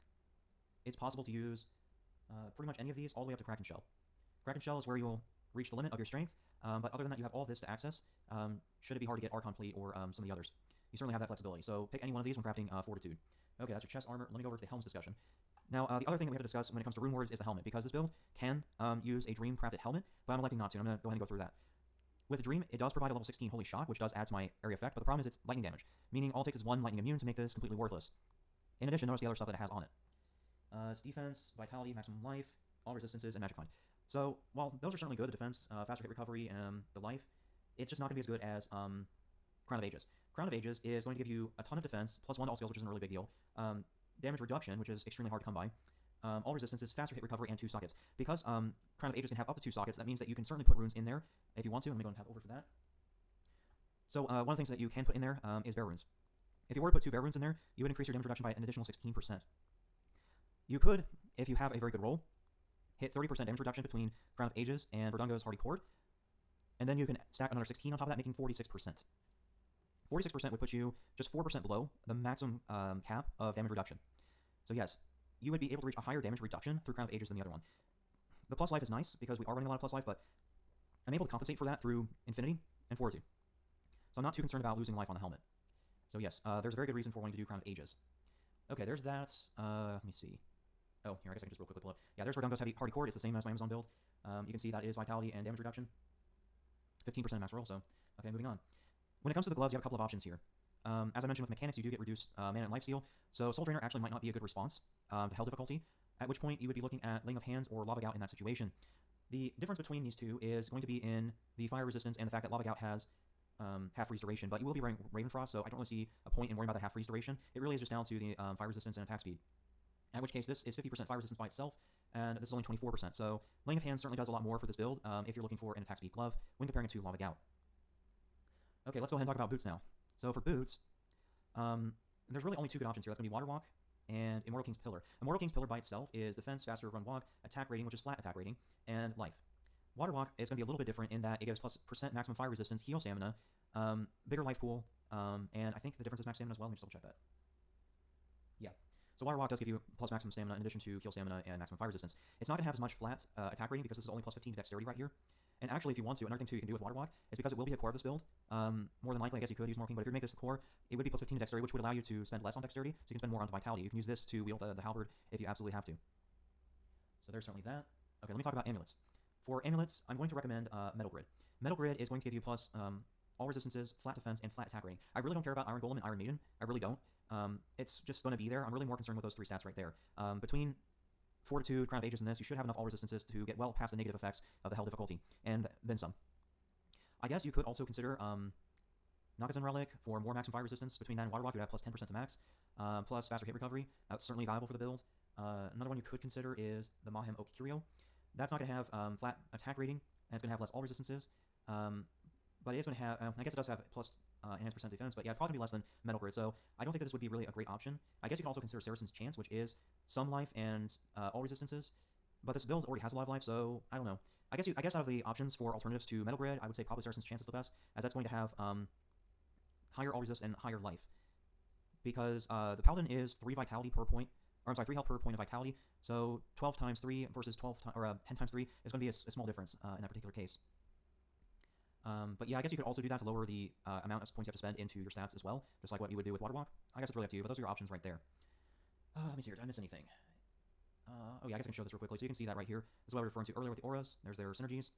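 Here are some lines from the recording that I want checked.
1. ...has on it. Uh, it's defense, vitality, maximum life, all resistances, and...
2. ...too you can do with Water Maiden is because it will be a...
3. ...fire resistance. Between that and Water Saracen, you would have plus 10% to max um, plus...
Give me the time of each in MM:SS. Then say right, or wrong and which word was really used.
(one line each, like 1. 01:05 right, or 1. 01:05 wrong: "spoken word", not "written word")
1. 00:29 right
2. 02:36 wrong: "Walk", not "Maiden"
3. 03:10 wrong: "Walk", not "Saracen".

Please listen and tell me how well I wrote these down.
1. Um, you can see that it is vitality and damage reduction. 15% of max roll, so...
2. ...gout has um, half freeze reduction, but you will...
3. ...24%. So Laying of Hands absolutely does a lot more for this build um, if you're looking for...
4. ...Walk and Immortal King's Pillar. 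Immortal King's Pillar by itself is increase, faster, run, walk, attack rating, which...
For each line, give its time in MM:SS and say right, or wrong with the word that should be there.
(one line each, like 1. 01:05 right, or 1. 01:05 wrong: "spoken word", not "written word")
1. 01:34 right
2. 01:52 wrong: "duration", not "reduction"
3. 02:02 wrong: "certainly", not "absolutely"
4. 02:13 wrong: "defense", not "increase".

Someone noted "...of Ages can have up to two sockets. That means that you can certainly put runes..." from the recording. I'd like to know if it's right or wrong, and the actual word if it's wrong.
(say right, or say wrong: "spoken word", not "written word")
right.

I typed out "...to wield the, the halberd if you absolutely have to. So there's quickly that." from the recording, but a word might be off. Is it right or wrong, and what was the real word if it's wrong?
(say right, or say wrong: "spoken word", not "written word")
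wrong: "certainly", not "quickly".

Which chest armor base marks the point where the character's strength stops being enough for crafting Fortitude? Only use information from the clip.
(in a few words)
Kraken Shell.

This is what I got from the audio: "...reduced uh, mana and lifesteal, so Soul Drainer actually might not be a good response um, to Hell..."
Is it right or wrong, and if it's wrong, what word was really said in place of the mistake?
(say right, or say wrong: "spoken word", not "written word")
right.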